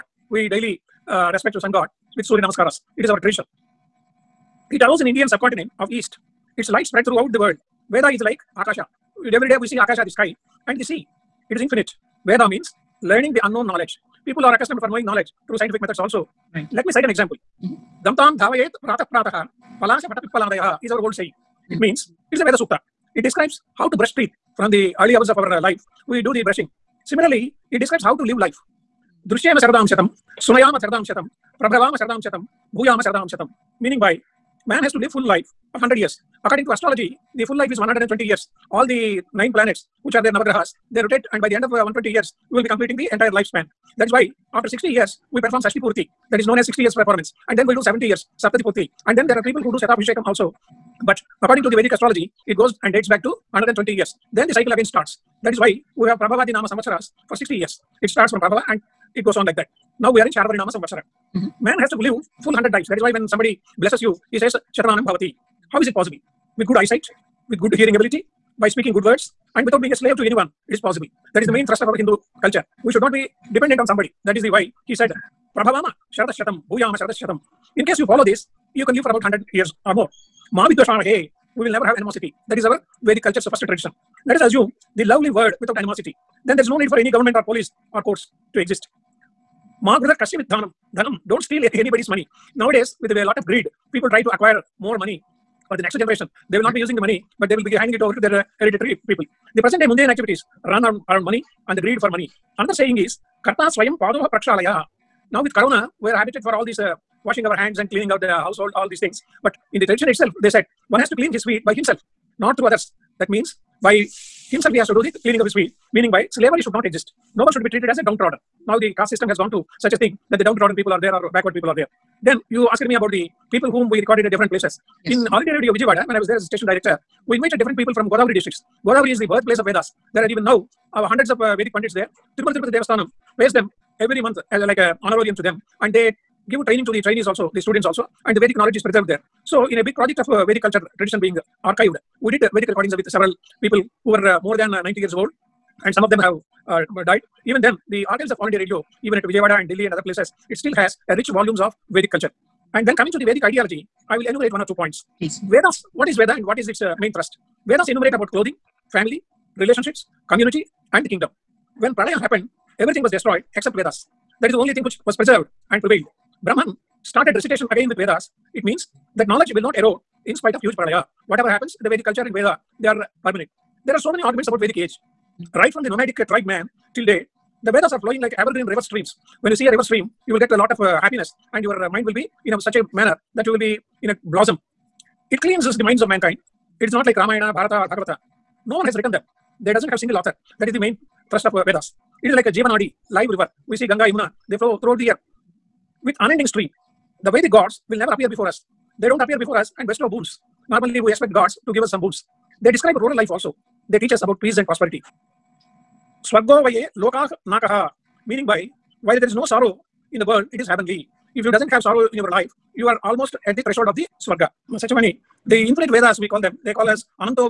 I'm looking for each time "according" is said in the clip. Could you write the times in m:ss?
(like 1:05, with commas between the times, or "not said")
0:36, 0:51.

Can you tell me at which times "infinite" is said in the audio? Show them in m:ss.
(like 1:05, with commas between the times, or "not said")
0:11, 3:35.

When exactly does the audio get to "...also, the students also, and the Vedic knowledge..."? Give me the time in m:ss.
2:17.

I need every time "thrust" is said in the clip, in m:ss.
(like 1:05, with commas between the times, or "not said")
1:11, 2:37, 3:11.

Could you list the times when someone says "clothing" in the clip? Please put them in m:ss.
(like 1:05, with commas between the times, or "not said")
2:38.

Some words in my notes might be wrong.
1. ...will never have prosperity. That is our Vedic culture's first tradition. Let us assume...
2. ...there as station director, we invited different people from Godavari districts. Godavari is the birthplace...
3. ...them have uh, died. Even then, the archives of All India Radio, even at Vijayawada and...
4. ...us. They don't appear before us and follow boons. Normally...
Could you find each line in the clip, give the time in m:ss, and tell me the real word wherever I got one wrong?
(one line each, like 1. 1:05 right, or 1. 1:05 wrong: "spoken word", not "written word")
1. 1:21 wrong: "animosity", not "prosperity"
2. 2:06 right
3. 2:26 right
4. 3:18 wrong: "bestow", not "follow".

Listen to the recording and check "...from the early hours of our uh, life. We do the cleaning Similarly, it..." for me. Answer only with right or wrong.
wrong.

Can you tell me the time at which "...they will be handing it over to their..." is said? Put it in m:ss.
1:37.